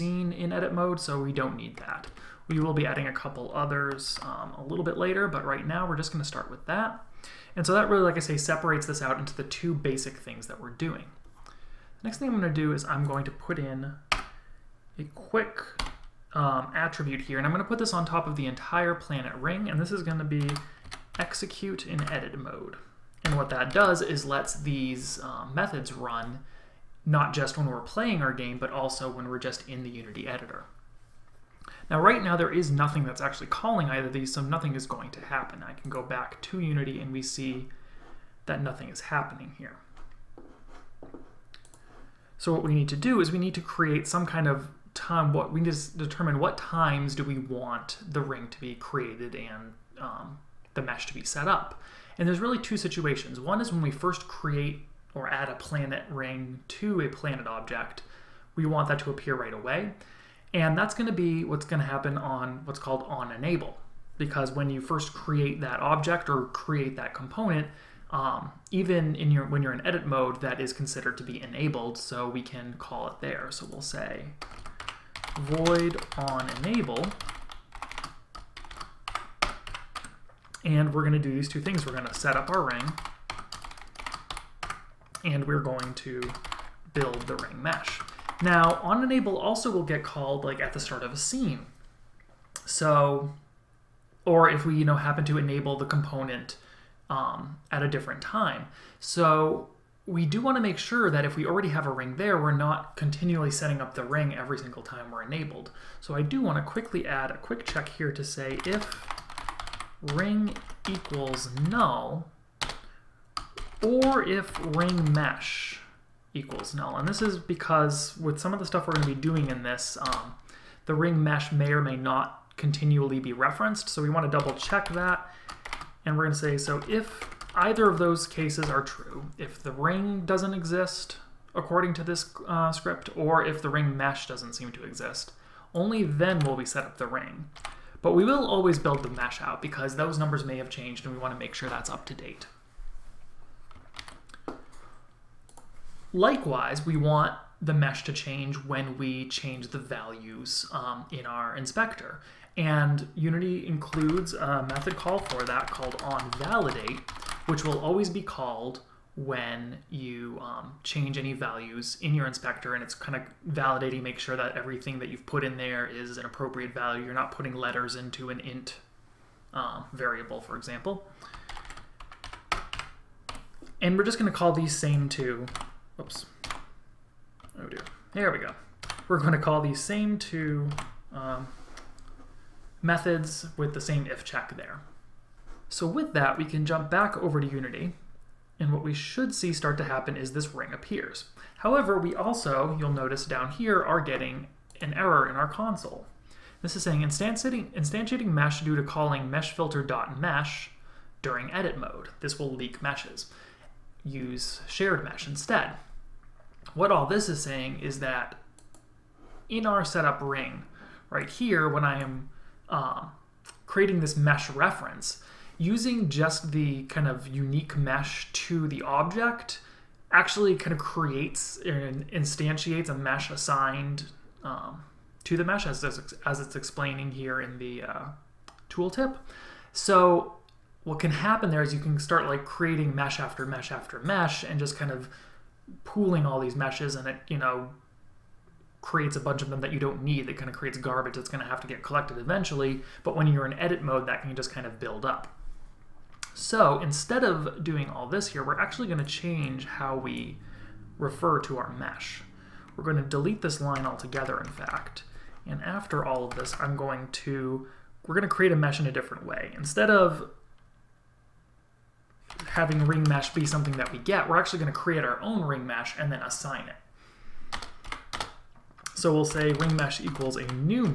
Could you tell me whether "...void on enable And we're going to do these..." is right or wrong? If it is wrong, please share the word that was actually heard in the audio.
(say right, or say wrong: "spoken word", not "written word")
right.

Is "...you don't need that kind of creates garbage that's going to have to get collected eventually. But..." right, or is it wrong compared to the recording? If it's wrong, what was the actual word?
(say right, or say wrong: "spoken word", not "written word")
right.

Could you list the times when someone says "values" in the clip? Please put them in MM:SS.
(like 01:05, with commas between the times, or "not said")
02:29, 02:41, 02:46.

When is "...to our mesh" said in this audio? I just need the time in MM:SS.
04:11.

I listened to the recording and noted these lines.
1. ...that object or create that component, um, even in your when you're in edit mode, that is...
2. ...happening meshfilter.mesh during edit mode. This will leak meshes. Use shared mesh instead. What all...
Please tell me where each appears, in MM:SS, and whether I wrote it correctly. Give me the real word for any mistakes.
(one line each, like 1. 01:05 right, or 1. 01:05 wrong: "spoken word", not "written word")
1. 01:05 right
2. 03:18 wrong: "calling", not "happening".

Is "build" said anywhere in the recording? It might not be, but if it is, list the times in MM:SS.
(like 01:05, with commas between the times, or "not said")
01:26, 02:18, 04:04.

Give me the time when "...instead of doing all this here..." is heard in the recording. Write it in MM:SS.
04:06.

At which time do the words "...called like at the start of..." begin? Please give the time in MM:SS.
01:30.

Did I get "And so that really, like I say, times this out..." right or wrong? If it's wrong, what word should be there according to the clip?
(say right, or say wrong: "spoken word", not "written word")
wrong: "separates", not "times".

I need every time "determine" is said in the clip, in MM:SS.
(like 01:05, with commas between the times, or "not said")
00:45.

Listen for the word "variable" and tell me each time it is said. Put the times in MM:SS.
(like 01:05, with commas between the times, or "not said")
02:49.